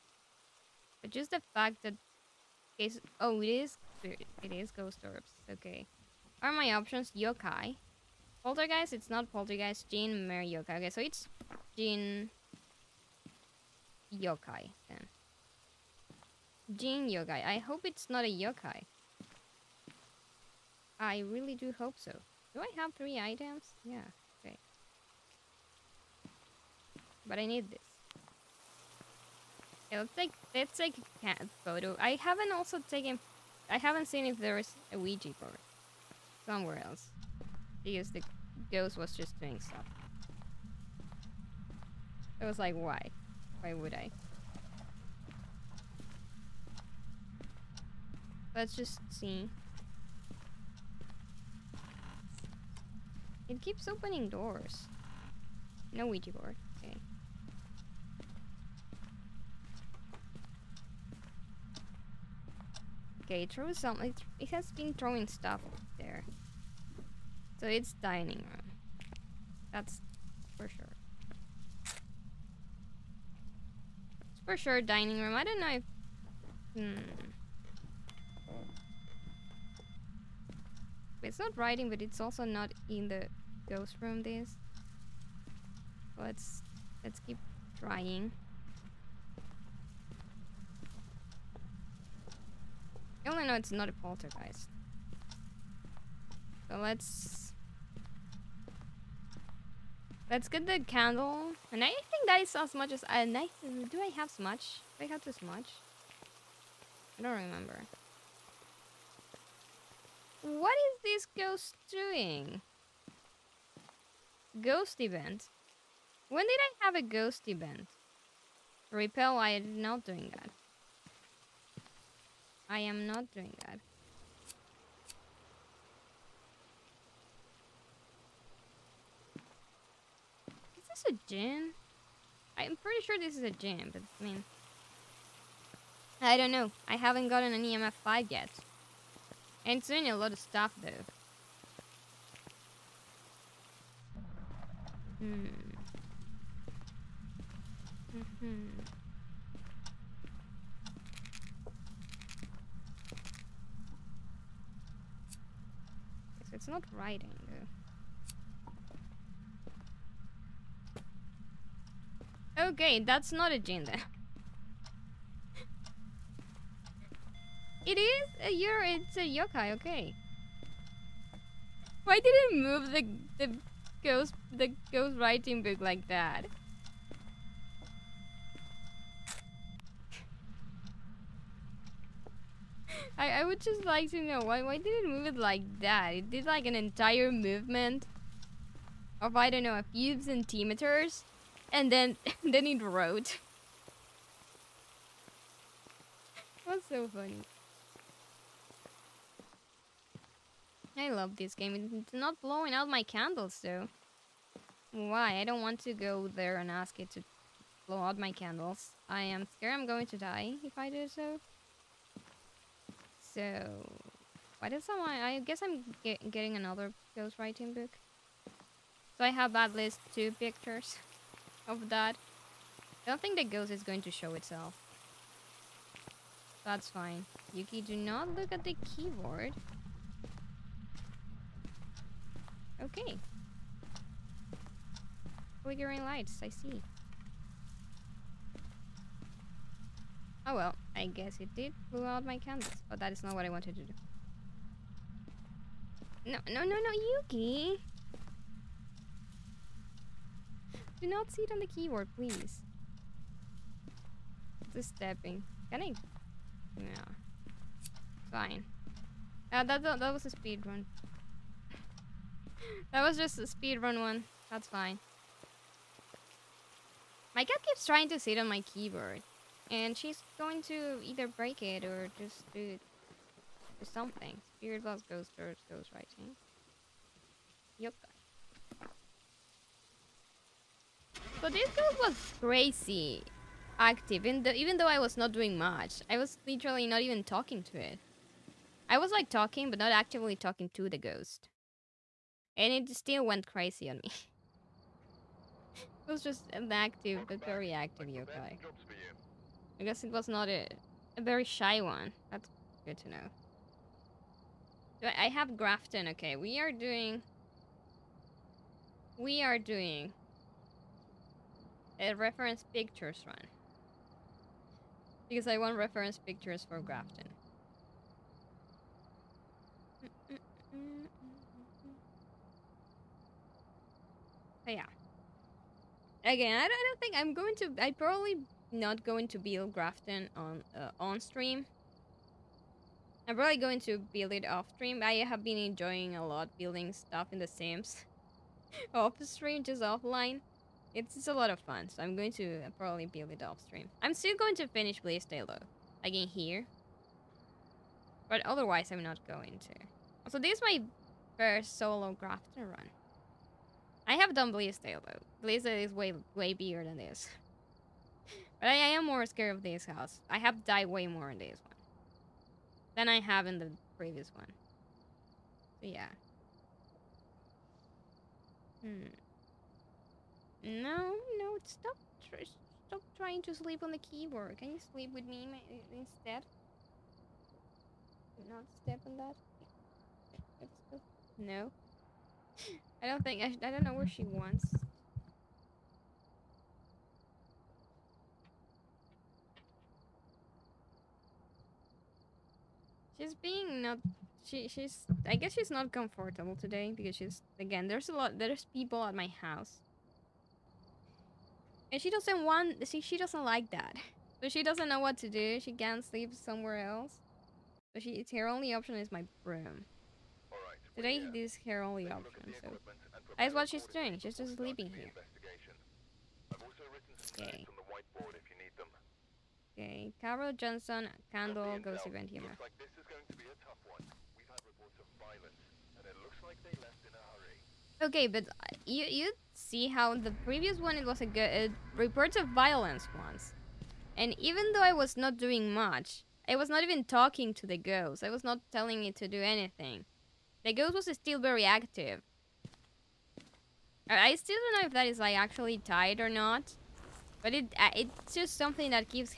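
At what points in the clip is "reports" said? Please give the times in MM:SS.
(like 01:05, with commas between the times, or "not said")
07:04, 07:11.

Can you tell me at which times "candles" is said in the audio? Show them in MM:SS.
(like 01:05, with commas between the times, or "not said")
01:40, 03:23, 03:28, 04:02, 07:01.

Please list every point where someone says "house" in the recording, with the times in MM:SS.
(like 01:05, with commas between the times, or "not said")
05:59, 06:39.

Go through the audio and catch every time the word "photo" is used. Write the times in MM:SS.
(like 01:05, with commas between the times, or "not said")
00:31.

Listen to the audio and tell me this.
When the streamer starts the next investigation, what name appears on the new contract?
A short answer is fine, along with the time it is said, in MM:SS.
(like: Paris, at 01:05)
Carol Johnson, at 07:00.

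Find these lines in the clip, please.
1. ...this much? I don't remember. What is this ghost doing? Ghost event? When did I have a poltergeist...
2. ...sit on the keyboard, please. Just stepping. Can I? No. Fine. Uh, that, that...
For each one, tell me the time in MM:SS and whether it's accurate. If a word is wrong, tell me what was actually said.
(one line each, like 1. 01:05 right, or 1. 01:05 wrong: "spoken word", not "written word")
1. 01:45 wrong: "ghost", not "poltergeist"
2. 04:11 right.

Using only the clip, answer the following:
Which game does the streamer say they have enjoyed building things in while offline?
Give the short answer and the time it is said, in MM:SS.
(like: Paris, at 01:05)
The Sims, at 05:37.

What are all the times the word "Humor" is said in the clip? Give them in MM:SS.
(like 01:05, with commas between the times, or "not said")
07:02.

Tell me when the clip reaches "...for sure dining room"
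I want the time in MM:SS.
01:14.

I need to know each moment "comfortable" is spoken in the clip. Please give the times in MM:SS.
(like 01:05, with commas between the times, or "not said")
06:35.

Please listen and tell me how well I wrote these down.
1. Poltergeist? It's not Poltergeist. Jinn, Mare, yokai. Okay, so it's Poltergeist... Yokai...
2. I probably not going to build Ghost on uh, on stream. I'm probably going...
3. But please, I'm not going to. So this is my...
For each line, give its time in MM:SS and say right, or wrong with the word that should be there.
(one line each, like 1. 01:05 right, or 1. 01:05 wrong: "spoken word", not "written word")
1. 00:08 wrong: "Jinn", not "Poltergeist"
2. 05:27 wrong: "Grafton", not "Ghost"
3. 05:48 wrong: "otherwise", not "please".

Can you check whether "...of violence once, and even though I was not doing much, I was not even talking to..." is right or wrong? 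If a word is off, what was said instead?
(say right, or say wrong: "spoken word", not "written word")
right.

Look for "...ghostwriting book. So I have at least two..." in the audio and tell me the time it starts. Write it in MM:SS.
03:37.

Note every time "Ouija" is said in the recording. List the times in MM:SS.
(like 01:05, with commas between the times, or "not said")
00:34, 00:56.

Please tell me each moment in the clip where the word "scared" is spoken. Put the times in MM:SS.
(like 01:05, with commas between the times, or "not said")
03:29, 05:59.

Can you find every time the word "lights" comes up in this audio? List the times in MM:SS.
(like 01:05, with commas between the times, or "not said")
03:56.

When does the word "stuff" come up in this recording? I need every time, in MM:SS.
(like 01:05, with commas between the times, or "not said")
00:39, 01:05, 02:20, 05:36.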